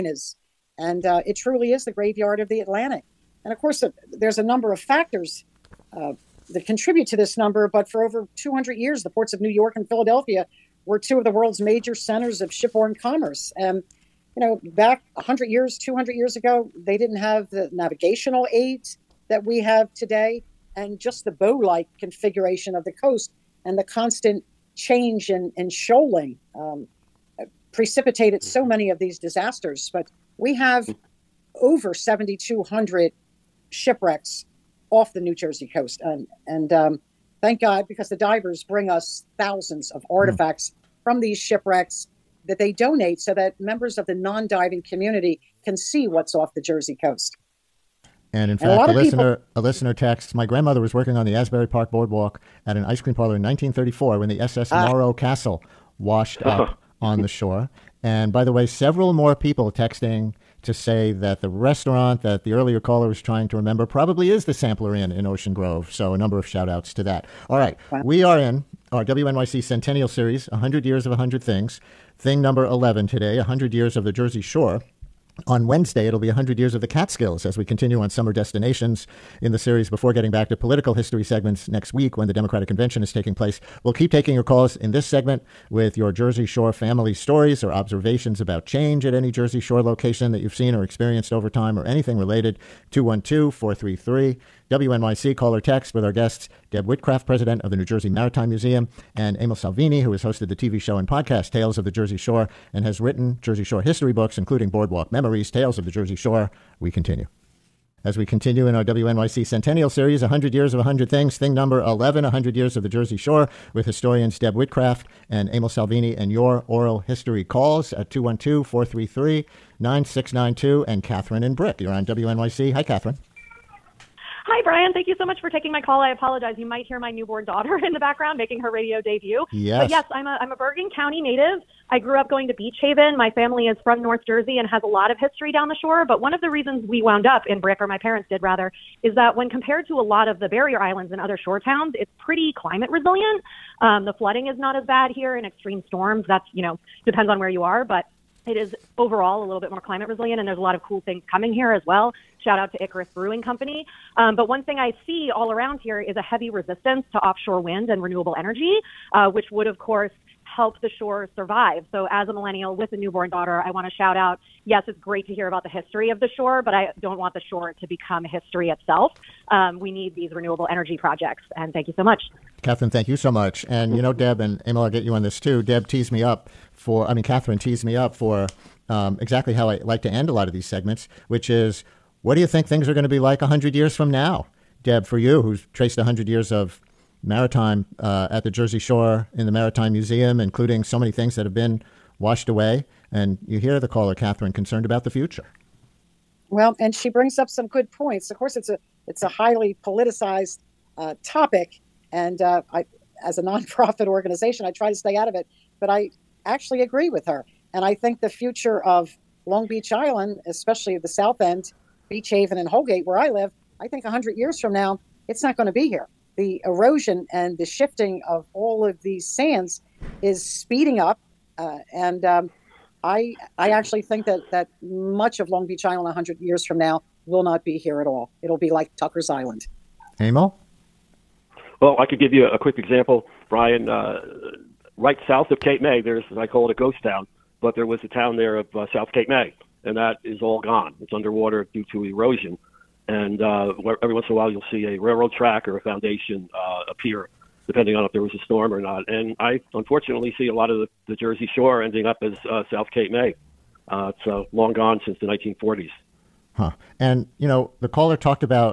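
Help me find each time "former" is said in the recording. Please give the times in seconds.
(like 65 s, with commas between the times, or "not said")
not said.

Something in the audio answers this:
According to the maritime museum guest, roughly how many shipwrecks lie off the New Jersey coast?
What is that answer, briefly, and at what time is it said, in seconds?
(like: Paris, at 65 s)
over 7,200, at 31 s.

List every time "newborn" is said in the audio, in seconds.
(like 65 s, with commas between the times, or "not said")
127 s, 162 s.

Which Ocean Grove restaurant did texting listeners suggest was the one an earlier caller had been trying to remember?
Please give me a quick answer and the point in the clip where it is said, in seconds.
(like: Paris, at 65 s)
Sampler Inn, at 64 s.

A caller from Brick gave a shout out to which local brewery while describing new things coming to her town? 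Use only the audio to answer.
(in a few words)
Icarus Brewing Company.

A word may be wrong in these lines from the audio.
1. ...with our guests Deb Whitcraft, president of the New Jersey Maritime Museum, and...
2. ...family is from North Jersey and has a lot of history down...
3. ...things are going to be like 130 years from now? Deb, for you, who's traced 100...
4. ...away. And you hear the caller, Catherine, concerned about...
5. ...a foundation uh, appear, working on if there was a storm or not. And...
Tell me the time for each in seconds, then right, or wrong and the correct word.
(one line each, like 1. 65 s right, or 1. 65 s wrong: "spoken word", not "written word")
1. 95 s right
2. 133 s right
3. 182 s wrong: "100", not "130"
4. 192 s right
5. 245 s wrong: "depending", not "working".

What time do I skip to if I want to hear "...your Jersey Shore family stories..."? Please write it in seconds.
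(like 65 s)
85 s.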